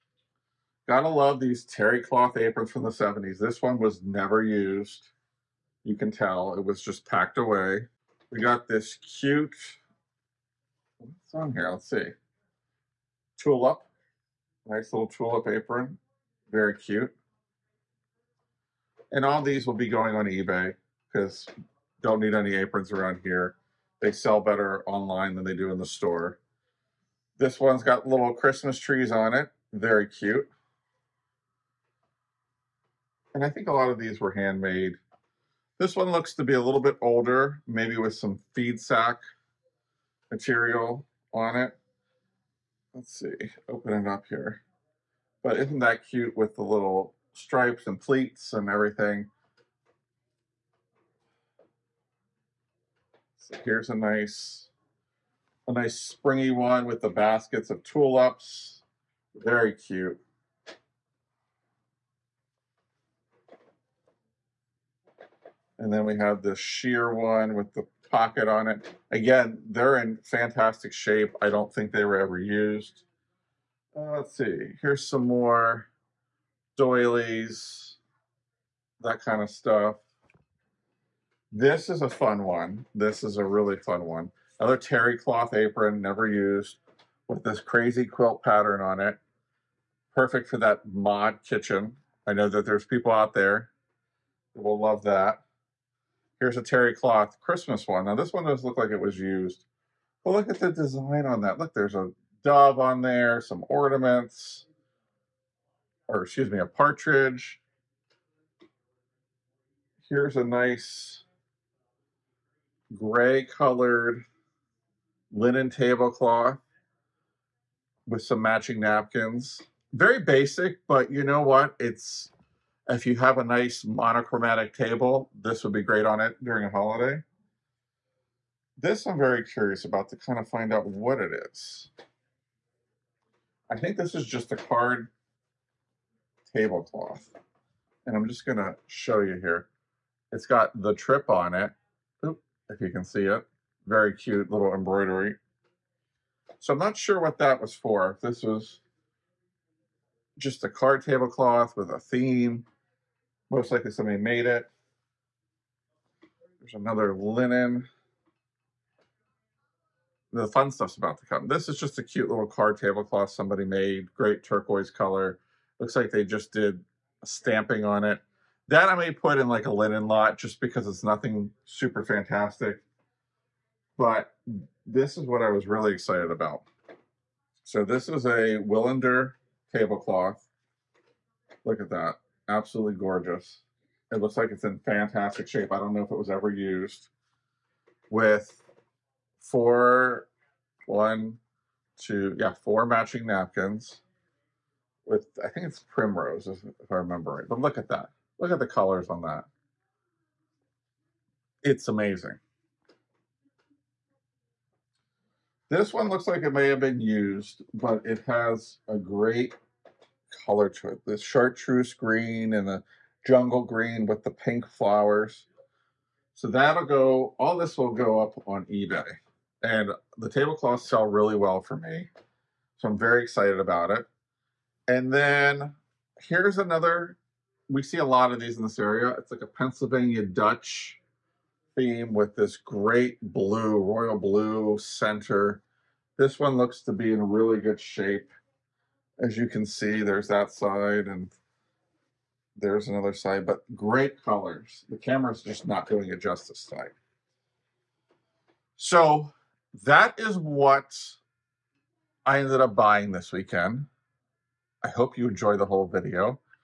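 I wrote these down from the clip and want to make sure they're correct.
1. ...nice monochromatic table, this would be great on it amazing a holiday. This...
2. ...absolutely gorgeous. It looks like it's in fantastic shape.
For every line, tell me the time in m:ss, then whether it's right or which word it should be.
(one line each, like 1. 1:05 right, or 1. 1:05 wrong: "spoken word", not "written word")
1. 2:03 wrong: "during", not "amazing"
2. 3:02 right.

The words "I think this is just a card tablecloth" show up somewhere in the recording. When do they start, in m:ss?
2:13.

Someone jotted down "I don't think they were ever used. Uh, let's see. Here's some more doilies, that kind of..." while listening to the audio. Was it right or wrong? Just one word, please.
right.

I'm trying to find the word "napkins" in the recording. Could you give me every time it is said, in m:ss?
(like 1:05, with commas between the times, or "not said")
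1:58, 3:13.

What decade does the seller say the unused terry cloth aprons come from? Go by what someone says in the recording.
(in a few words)
1970s.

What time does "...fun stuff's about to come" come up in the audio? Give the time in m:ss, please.
2:40.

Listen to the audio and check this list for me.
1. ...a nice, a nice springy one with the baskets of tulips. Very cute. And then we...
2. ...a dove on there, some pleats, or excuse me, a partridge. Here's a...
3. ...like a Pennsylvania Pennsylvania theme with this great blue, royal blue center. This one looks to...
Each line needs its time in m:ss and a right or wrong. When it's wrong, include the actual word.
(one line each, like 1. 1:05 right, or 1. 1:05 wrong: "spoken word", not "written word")
1. 0:53 right
2. 1:41 wrong: "ornaments", not "pleats"
3. 3:49 wrong: "Dutch", not "Pennsylvania".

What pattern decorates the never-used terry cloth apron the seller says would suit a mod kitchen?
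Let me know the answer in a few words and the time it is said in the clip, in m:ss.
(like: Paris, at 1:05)
Crazy quilt, at 1:27.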